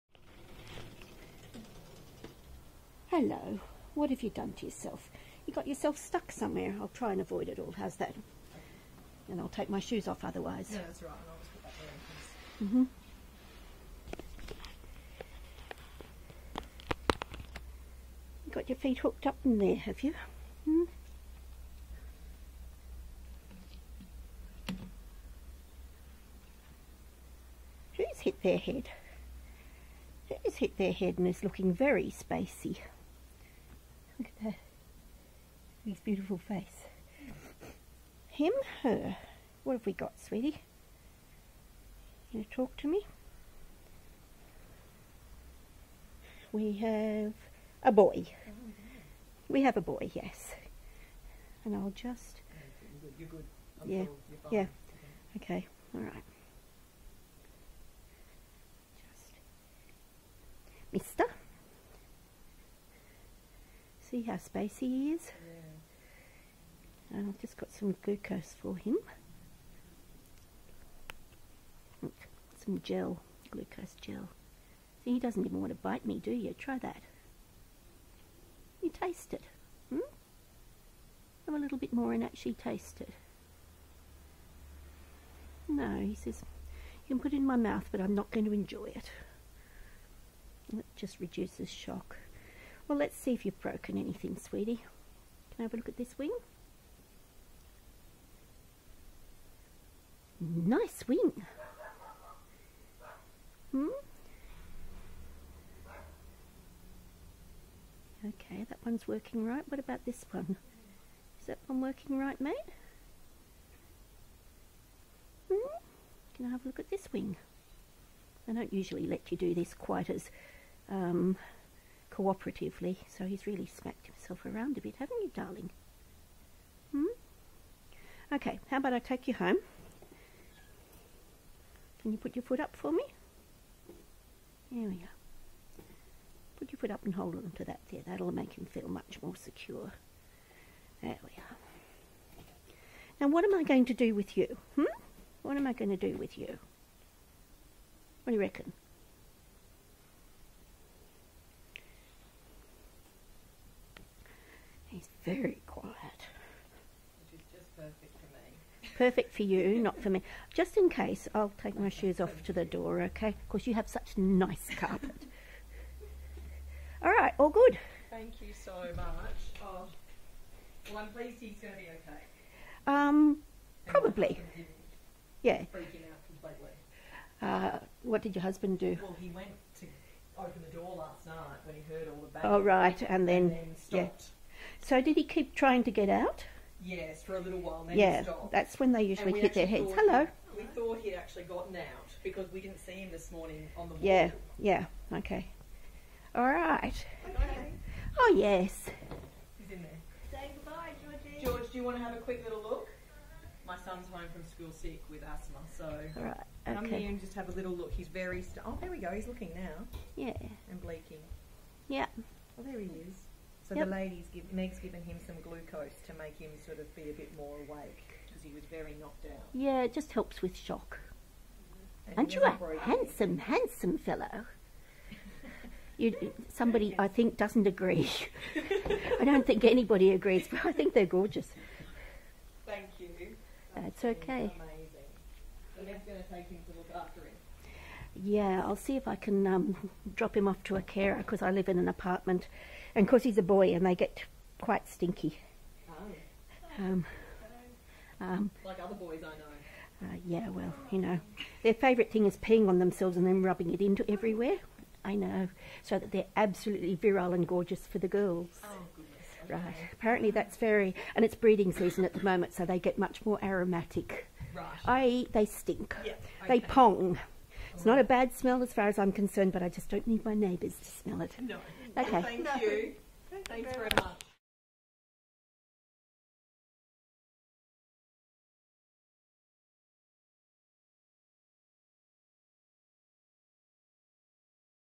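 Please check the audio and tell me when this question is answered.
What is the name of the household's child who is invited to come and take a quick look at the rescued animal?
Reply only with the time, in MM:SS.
03:21.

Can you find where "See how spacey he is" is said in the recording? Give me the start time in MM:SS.
01:04.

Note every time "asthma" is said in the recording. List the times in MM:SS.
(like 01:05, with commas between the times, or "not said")
03:25.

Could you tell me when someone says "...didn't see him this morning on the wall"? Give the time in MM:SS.
03:12.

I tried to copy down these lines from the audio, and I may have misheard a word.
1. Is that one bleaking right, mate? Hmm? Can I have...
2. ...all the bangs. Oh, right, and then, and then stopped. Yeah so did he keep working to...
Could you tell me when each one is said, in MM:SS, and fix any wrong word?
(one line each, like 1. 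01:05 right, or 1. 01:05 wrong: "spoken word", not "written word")
1. 01:51 wrong: "working", not "bleaking"
2. 03:02 wrong: "trying", not "working".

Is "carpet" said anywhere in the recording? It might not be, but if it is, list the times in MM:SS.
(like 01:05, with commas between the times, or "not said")
02:44.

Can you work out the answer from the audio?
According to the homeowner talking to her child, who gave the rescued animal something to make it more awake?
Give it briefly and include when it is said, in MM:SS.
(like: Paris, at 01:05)
Meg, at 03:34.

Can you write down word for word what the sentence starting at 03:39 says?
Yeah, it just helps with shock.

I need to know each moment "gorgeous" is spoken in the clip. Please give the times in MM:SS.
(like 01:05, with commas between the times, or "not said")
03:51, 04:17.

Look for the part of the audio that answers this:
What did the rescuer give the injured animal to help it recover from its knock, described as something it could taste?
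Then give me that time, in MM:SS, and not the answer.
01:13.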